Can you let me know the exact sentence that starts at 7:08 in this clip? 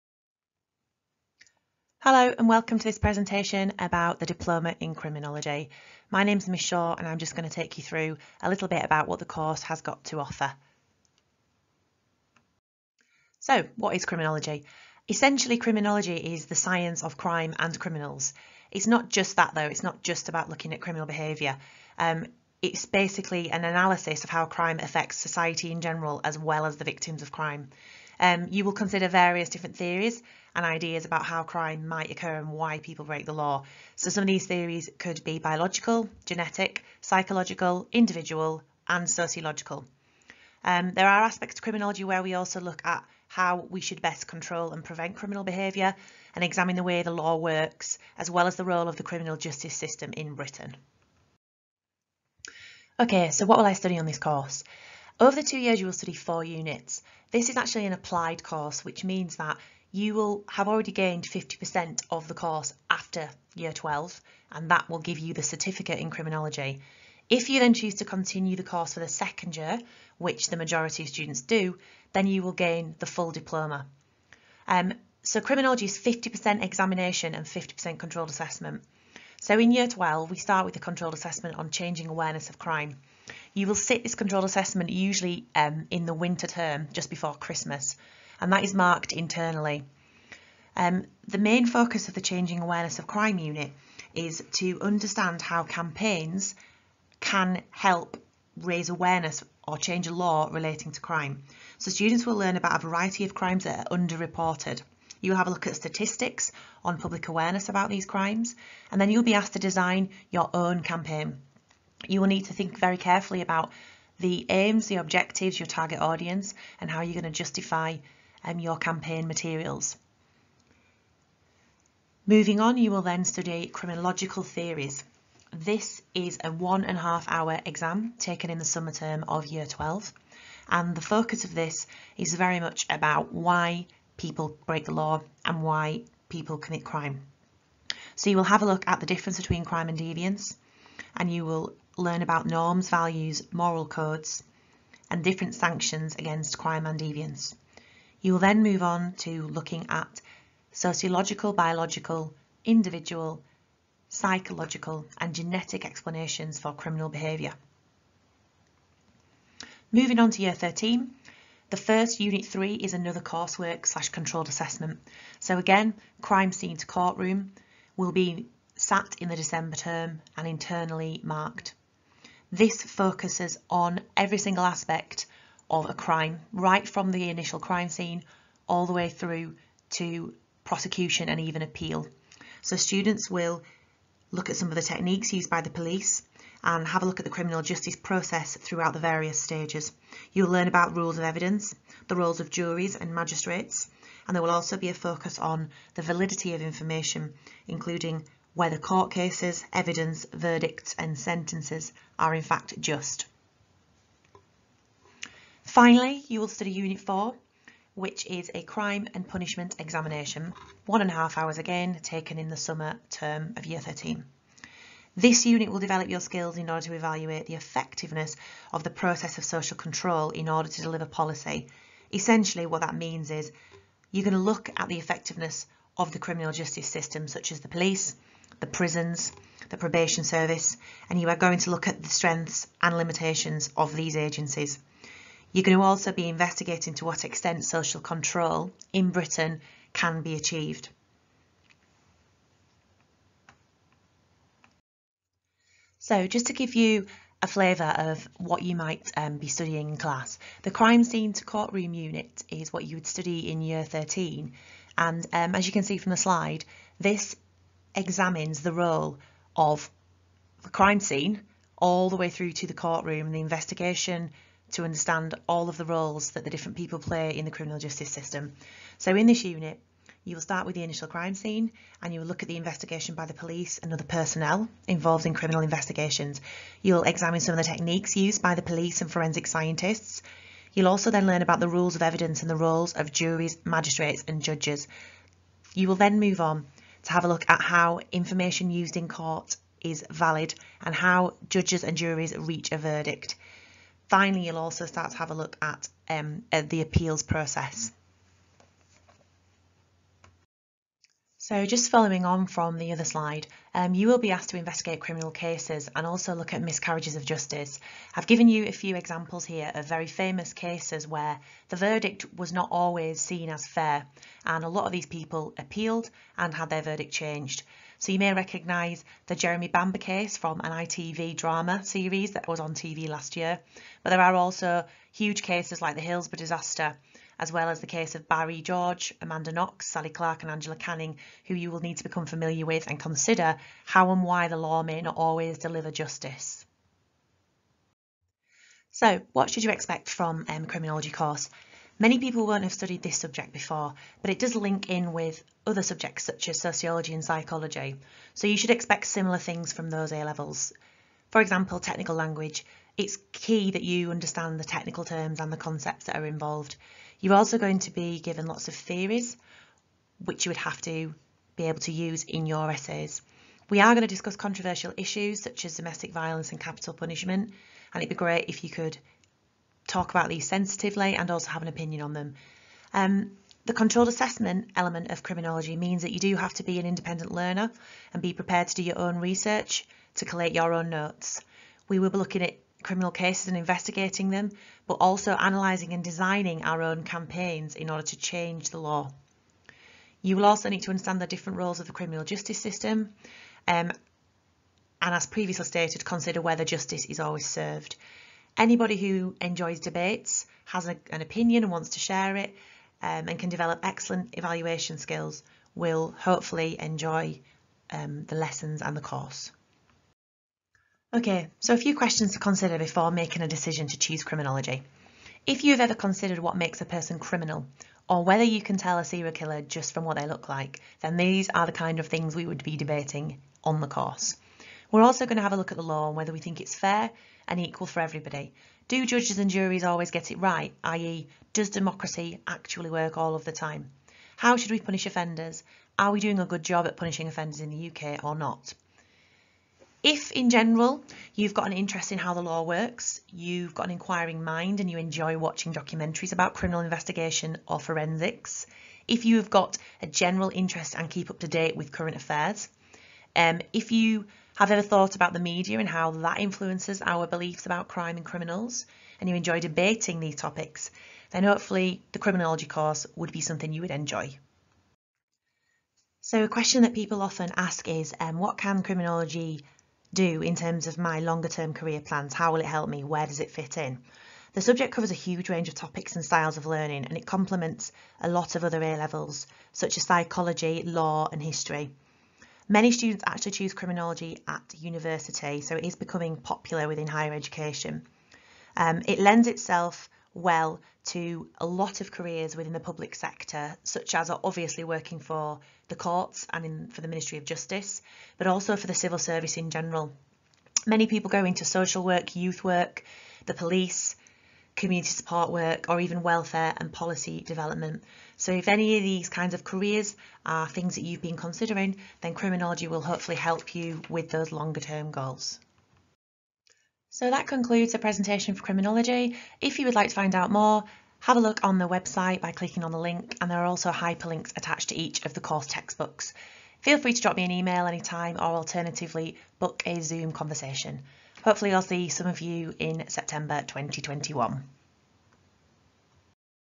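Do judges and juries always get it right, i.e.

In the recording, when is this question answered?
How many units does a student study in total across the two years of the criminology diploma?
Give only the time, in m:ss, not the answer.
0:56.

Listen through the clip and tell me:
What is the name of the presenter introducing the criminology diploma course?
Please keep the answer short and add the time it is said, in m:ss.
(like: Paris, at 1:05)
Miss Shaw, at 0:06.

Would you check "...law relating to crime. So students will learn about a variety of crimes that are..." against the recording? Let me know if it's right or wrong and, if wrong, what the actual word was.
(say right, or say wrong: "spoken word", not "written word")
right.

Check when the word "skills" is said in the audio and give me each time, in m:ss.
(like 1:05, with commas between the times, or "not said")
3:36, 6:44.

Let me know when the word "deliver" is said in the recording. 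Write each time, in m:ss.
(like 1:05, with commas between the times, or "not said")
3:40, 5:35.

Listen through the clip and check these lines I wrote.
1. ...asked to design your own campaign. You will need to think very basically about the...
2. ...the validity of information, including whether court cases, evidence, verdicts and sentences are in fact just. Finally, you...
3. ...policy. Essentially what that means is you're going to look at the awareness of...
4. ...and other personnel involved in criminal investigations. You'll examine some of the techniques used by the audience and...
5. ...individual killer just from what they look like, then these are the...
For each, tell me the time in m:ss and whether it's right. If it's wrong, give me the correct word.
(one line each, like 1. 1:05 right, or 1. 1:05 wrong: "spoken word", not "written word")
1. 1:49 wrong: "carefully", not "basically"
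2. 3:15 right
3. 3:41 wrong: "effectiveness", not "awareness"
4. 4:33 wrong: "police", not "audience"
5. 6:59 wrong: "serial", not "individual".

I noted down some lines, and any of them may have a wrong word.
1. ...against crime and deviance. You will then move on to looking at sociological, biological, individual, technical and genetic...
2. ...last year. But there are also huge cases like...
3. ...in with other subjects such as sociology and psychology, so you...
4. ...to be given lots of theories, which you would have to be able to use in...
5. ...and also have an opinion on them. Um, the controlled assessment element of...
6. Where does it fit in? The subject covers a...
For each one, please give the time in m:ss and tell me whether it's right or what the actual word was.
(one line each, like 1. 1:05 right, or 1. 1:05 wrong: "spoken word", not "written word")
1. 2:26 wrong: "psychological", not "technical"
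2. 5:23 right
3. 5:44 right
4. 5:57 right
5. 6:11 right
6. 7:53 right.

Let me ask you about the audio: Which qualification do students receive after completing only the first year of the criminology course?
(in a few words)
certificate in criminology.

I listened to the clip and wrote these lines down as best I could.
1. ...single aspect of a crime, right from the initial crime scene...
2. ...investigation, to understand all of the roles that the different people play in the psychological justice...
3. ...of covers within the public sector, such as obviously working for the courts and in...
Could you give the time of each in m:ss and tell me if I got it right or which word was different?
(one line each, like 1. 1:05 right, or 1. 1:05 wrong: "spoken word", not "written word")
1. 2:54 right
2. 4:23 wrong: "criminal", not "psychological"
3. 8:11 wrong: "careers", not "covers".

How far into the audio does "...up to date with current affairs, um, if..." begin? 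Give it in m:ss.
7:31.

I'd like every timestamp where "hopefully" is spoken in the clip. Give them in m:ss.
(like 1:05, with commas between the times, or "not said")
6:46, 7:41, 8:33, 8:51.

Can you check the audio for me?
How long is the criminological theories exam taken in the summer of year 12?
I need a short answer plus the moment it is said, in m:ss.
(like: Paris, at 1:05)
1.5 hours, at 2:06.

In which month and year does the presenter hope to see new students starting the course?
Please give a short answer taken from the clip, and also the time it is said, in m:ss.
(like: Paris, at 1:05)
September 2021, at 8:53.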